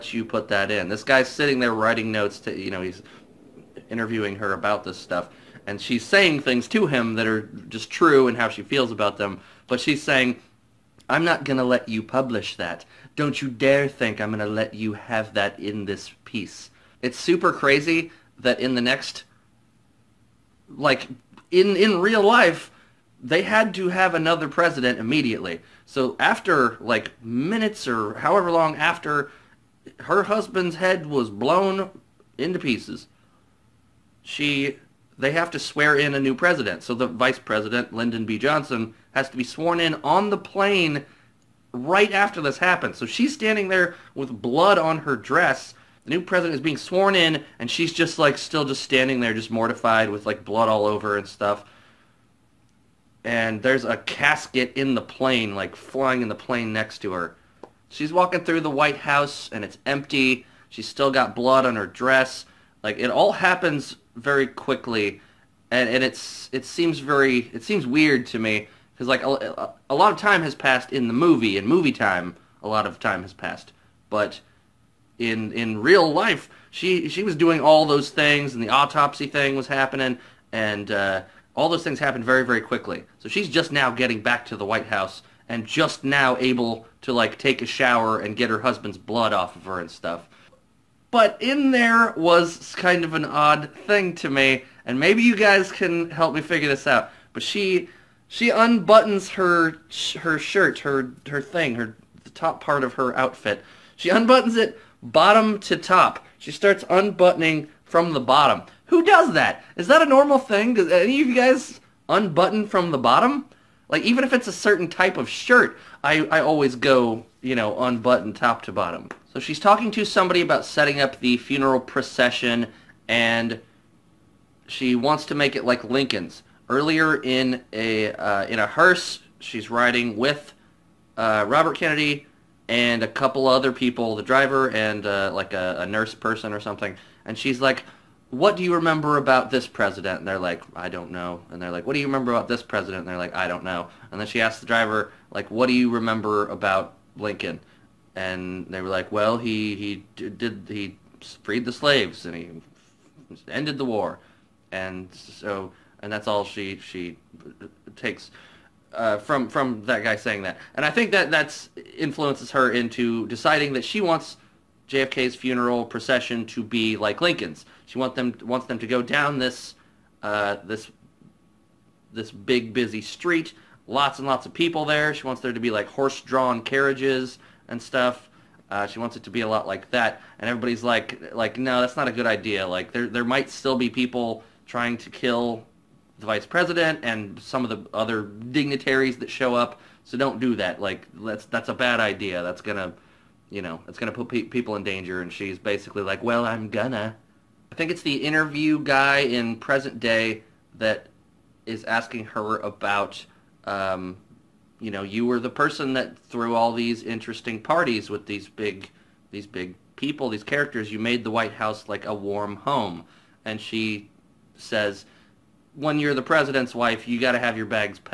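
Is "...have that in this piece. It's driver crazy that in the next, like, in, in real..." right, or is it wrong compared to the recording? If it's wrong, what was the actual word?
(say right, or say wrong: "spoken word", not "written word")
wrong: "super", not "driver".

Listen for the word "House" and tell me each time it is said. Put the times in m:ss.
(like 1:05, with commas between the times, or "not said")
0:58, 1:24, 3:31.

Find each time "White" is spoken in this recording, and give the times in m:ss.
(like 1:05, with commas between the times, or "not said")
0:58, 1:24, 3:31.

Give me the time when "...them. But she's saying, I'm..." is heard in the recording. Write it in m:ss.
0:09.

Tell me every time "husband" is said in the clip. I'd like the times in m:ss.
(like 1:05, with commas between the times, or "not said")
0:30, 1:28.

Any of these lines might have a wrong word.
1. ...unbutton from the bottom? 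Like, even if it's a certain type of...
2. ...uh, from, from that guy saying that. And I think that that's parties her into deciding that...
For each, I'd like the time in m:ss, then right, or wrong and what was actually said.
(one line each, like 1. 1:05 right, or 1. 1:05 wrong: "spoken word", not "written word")
1. 1:52 right
2. 2:38 wrong: "influences", not "parties".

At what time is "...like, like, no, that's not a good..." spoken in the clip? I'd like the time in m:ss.
3:00.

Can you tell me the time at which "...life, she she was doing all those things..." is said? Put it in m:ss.
1:16.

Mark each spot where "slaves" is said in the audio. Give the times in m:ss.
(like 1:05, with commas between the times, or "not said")
2:31.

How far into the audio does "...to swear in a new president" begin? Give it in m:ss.
0:35.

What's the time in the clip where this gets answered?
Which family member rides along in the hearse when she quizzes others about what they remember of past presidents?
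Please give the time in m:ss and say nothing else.
2:11.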